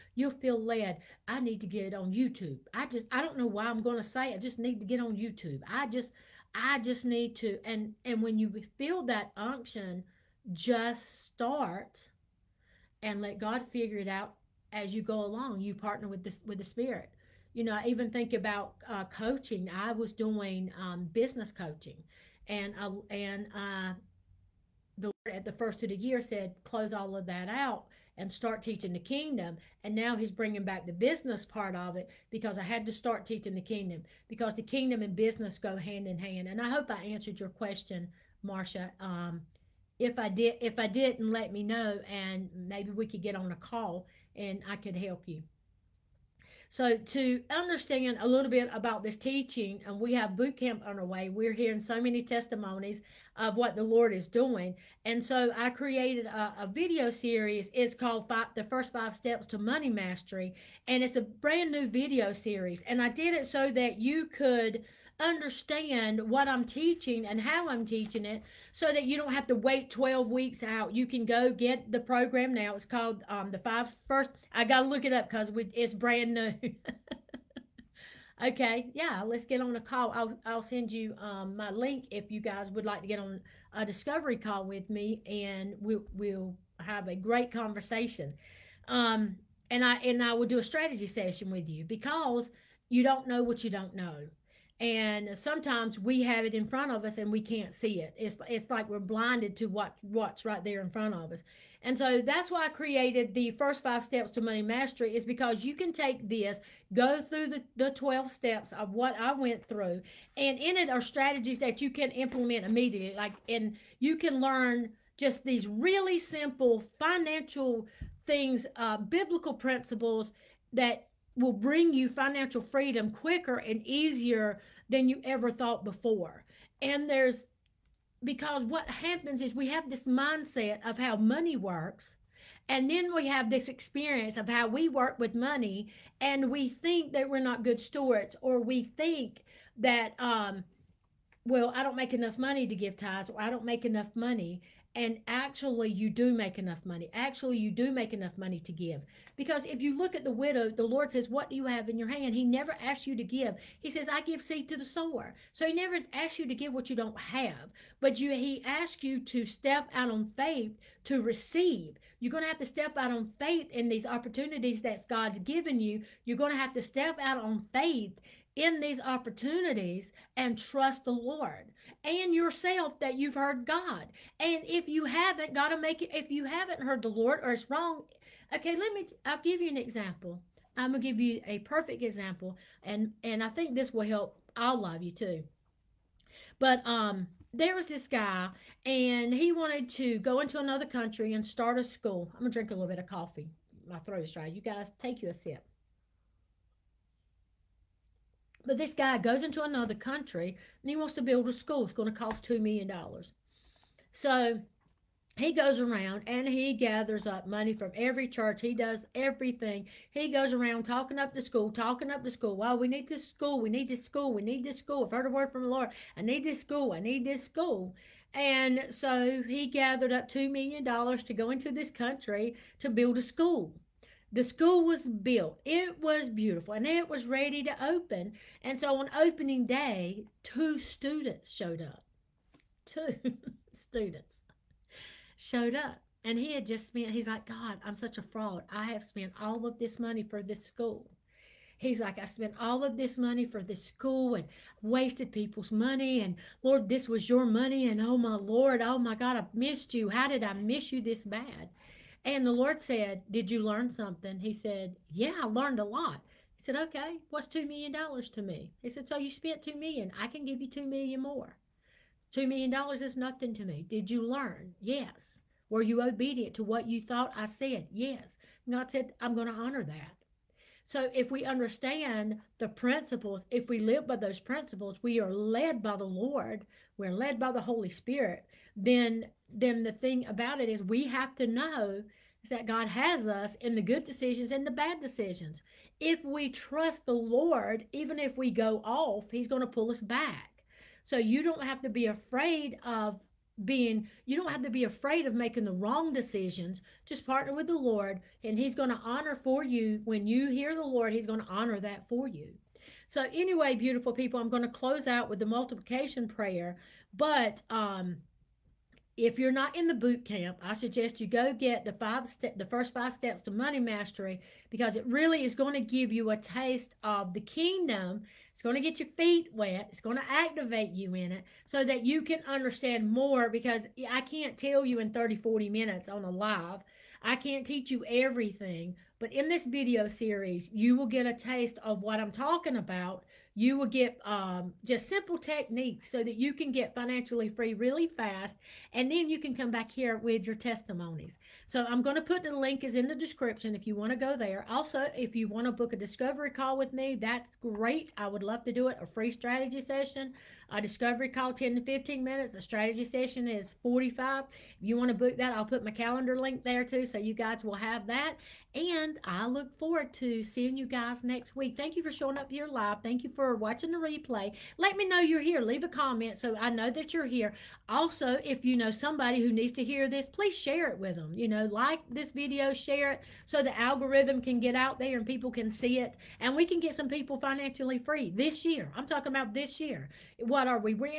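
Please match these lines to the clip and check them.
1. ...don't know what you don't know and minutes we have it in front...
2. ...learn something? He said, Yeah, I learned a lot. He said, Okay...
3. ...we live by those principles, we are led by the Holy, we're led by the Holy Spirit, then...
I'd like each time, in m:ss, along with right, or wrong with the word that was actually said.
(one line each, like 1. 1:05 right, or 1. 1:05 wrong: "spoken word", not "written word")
1. 1:33 wrong: "sometimes", not "minutes"
2. 4:13 right
3. 4:33 wrong: "Lord", not "Holy".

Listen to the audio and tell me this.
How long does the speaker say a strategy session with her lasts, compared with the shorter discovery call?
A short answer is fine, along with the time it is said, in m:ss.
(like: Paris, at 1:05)
45 minutes, at 5:53.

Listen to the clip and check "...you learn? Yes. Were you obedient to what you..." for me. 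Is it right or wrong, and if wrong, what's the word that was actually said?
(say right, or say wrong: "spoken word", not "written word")
right.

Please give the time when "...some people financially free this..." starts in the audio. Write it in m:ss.
6:16.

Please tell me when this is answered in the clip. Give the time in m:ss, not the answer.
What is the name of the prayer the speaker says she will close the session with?
5:05.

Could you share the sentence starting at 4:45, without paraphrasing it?
If we trust the Lord, even if we go off, he's going to pull us back.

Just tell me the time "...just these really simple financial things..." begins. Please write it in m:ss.
1:55.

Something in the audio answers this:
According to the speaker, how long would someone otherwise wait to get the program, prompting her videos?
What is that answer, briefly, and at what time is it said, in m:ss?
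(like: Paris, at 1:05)
12 weeks, at 1:09.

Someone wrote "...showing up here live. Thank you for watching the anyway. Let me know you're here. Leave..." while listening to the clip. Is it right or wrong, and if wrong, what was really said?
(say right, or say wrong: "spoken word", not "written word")
wrong: "replay", not "anyway".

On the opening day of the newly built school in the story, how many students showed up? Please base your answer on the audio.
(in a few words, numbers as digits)
2.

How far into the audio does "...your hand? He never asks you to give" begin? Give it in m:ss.
2:31.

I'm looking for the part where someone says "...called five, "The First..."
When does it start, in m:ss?
0:57.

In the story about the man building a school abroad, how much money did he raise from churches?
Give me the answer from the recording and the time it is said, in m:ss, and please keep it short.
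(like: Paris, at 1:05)
$2 million, at 3:40.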